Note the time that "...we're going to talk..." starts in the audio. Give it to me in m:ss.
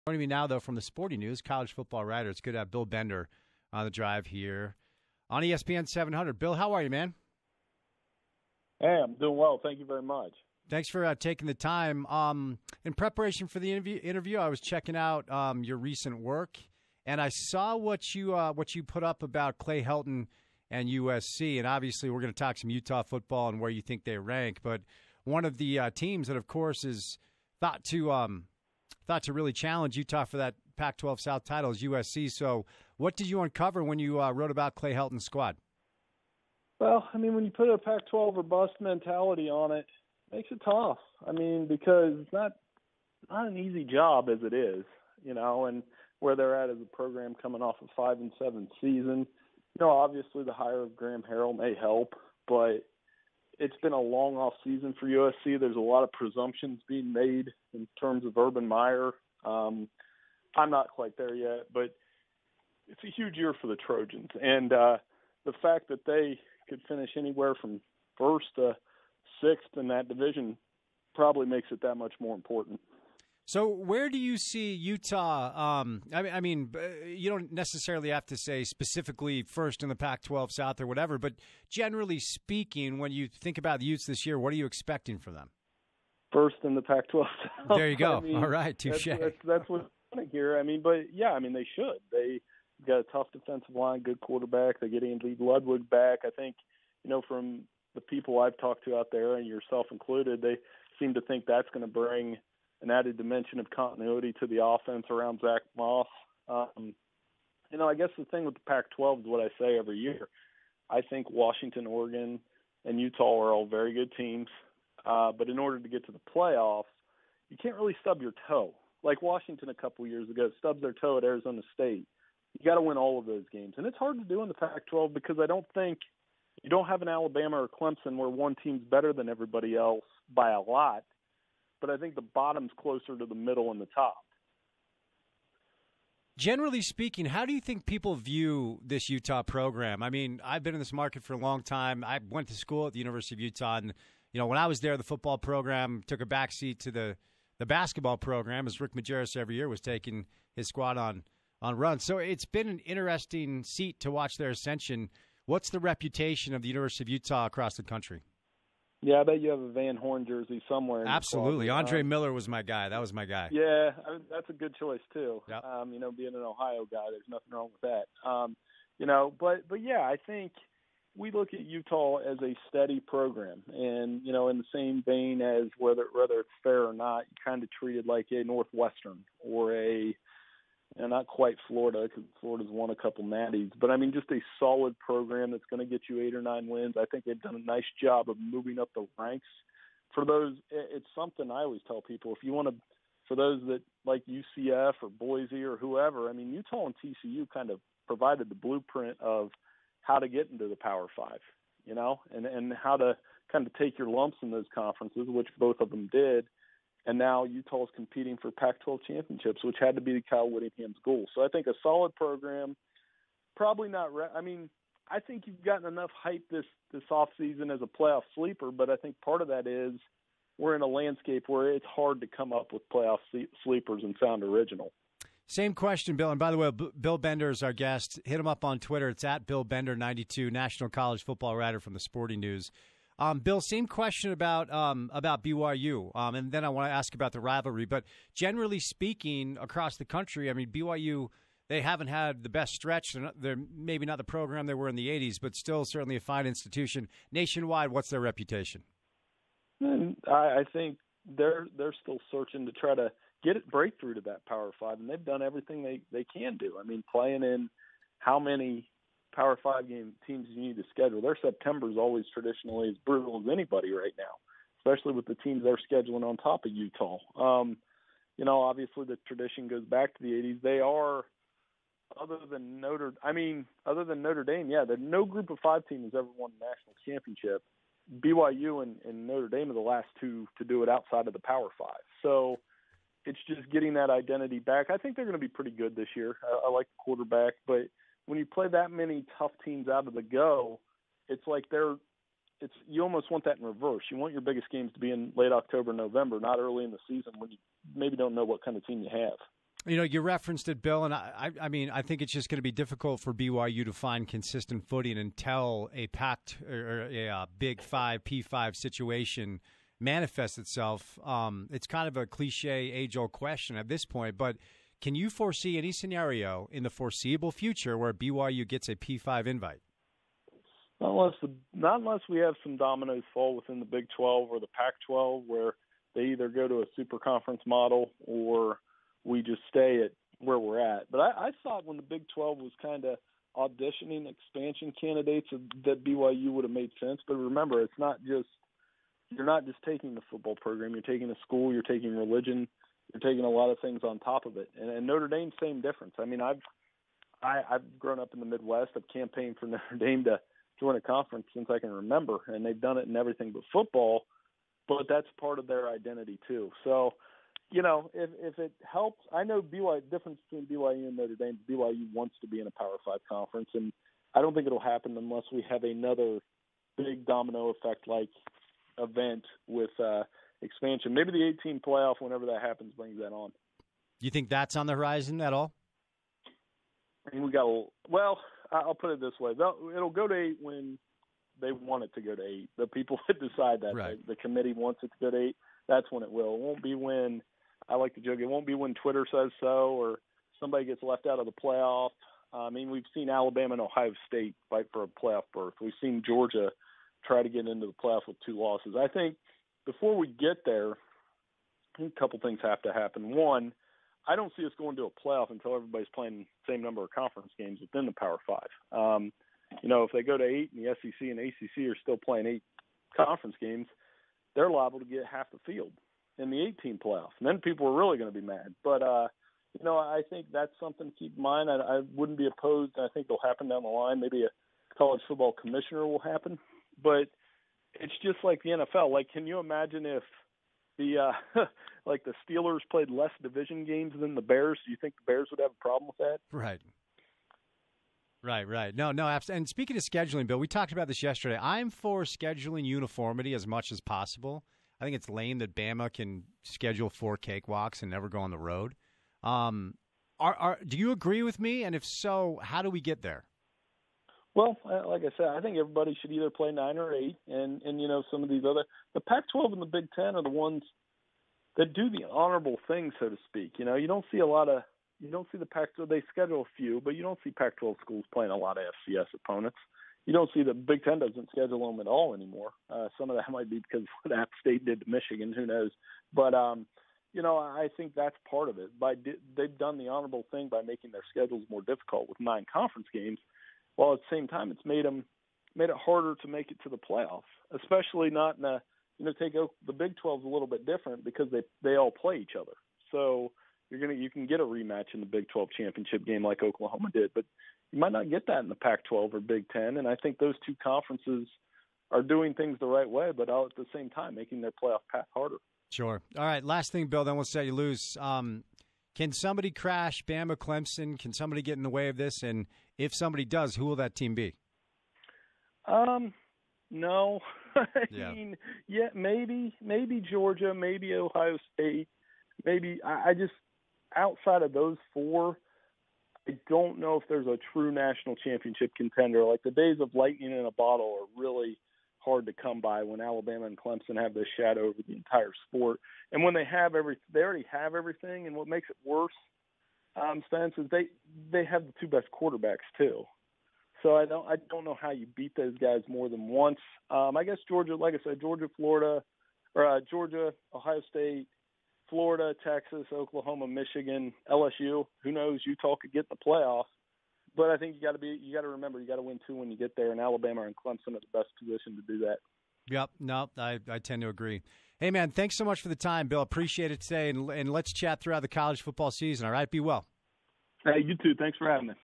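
0:22.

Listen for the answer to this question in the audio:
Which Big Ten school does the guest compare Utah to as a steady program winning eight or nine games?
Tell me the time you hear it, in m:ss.
2:58.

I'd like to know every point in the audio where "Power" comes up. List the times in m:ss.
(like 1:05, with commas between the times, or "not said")
3:20, 4:14, 4:19, 4:41, 6:02, 6:48.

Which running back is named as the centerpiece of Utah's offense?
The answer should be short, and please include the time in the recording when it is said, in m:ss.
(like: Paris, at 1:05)
Zach Moss, at 1:45.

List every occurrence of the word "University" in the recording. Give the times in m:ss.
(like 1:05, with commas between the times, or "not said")
2:22, 2:36.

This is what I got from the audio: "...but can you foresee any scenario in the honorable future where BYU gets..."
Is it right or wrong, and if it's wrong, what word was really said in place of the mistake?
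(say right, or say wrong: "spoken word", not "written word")
wrong: "foreseeable", not "honorable".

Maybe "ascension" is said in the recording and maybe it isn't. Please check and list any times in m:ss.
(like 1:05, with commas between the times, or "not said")
2:34.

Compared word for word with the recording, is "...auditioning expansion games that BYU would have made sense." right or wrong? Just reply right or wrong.
wrong.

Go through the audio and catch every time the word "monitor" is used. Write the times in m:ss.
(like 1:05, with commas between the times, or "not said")
not said.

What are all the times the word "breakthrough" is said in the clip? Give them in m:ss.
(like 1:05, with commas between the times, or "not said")
4:13.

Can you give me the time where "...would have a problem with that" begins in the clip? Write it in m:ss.
7:15.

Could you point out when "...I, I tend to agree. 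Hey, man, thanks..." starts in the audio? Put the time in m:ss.
9:23.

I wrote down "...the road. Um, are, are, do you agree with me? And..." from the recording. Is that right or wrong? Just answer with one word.
right.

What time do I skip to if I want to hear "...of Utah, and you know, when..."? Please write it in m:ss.
2:23.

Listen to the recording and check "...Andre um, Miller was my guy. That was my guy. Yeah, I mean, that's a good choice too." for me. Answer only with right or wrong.
right.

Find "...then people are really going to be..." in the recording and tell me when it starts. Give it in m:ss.
6:57.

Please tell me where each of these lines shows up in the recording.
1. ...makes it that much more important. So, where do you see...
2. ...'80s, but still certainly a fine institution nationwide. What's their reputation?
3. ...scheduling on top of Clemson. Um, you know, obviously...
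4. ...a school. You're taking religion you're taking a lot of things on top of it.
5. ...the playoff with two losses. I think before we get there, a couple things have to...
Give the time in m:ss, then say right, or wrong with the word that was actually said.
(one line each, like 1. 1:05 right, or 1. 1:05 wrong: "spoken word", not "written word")
1. 1:11 right
2. 4:05 right
3. 4:25 wrong: "Utah", not "Clemson"
4. 5:41 right
5. 6:37 right.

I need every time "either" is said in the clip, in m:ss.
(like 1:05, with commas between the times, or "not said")
5:26, 7:36.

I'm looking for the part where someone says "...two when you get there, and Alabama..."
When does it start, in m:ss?
9:19.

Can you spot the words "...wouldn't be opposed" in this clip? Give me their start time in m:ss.
7:02.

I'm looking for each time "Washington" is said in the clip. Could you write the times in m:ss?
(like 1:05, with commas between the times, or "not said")
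1:51, 1:59.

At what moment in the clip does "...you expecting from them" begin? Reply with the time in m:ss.
1:24.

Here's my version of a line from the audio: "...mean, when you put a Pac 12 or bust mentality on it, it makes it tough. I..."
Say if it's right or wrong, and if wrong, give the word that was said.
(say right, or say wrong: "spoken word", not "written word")
right.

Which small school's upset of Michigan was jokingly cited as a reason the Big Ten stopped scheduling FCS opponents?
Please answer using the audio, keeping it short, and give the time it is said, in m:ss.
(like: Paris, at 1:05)
App State, at 7:54.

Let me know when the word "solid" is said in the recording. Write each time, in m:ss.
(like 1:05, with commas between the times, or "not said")
3:04, 3:31.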